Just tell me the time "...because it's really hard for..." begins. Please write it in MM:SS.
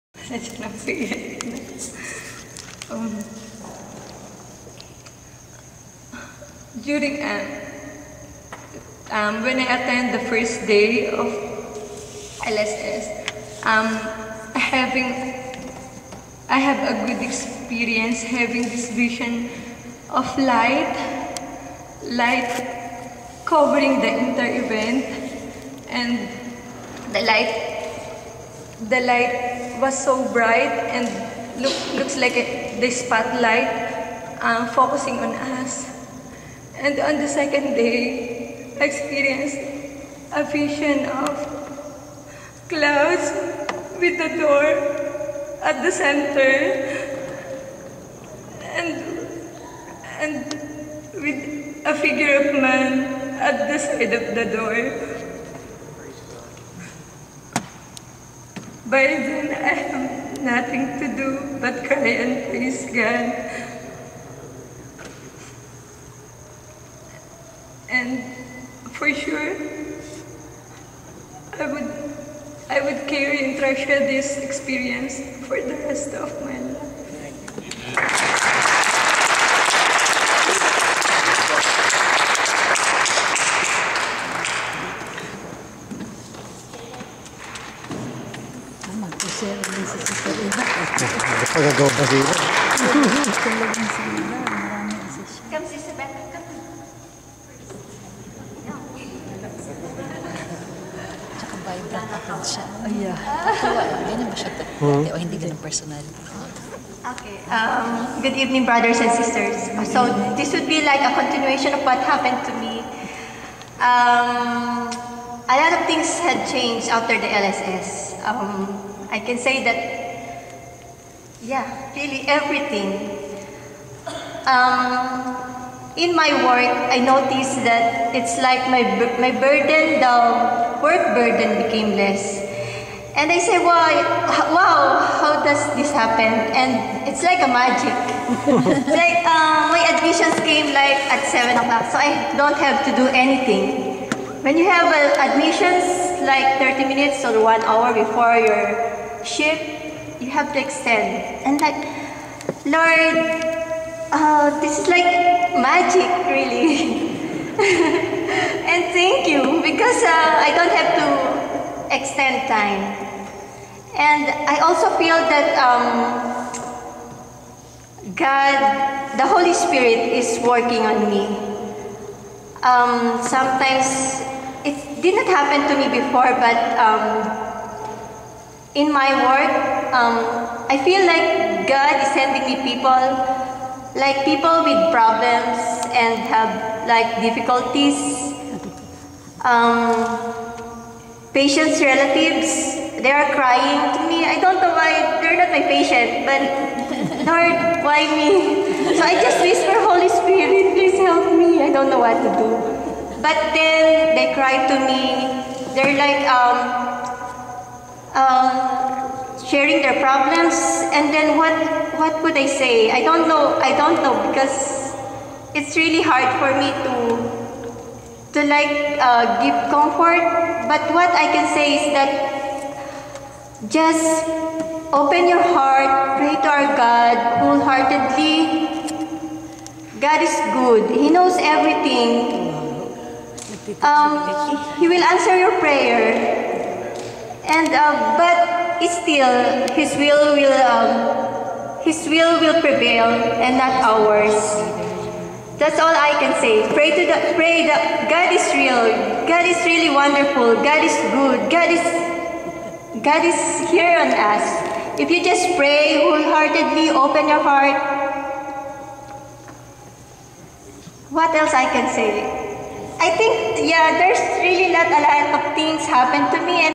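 03:34.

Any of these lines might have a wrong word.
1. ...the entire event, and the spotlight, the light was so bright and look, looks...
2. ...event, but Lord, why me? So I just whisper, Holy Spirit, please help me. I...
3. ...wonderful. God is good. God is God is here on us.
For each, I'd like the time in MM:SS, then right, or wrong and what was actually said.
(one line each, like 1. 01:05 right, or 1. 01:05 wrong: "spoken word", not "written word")
1. 00:23 wrong: "light", not "spotlight"
2. 03:15 wrong: "patient", not "event"
3. 04:09 right.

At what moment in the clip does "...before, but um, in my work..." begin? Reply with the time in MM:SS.
02:55.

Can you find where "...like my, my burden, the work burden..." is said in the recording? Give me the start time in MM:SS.
02:08.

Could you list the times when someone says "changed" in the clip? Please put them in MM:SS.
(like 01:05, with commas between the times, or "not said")
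01:56.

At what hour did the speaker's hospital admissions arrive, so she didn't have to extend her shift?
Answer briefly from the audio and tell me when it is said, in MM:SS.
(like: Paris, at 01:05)
7, at 02:21.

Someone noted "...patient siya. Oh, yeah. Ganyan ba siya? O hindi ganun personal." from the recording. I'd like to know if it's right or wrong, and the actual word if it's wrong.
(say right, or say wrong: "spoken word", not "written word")
wrong: "account", not "patient".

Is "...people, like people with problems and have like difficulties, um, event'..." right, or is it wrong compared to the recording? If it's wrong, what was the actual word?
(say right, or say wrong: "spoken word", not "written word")
wrong: "patients", not "event".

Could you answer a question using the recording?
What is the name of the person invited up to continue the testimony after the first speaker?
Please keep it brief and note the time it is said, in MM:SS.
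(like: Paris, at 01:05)
Beth, at 01:35.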